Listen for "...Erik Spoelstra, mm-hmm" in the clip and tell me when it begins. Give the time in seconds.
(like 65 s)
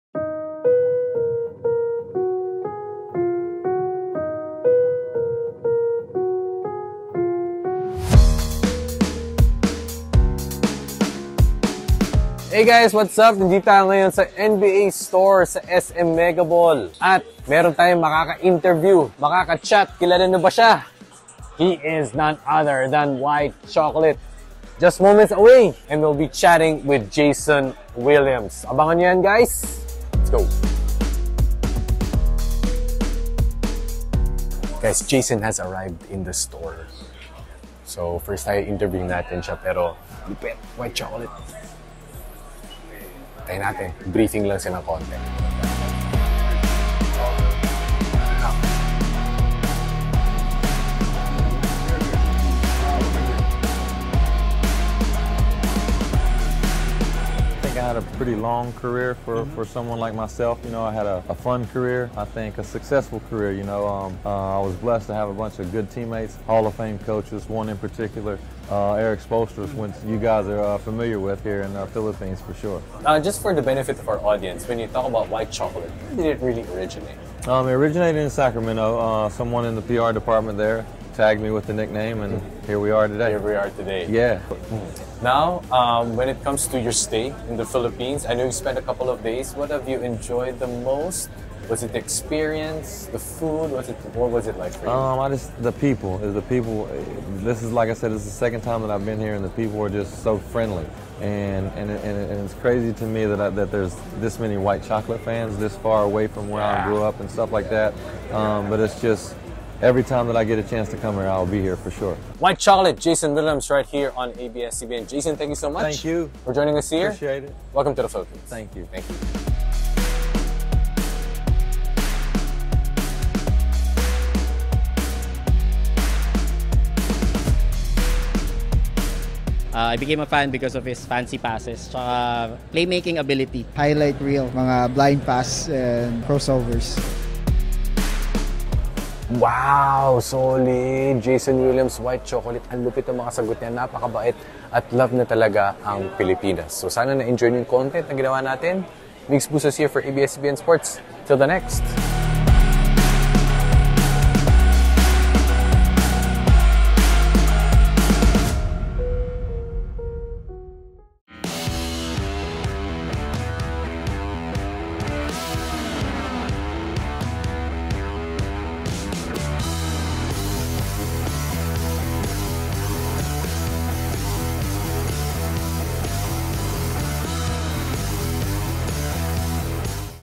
69 s.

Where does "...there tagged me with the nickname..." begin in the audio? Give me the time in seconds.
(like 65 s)
80 s.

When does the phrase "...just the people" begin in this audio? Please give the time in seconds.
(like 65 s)
95 s.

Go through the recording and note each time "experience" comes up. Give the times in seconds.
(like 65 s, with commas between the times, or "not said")
91 s.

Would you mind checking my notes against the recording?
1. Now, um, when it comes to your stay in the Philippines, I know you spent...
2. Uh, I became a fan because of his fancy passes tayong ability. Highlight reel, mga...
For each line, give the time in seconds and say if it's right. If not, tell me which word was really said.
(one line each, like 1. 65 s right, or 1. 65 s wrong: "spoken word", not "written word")
1. 85 s right
2. 129 s wrong: "playmaking", not "tayong".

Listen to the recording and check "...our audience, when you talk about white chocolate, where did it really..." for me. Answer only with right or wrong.
right.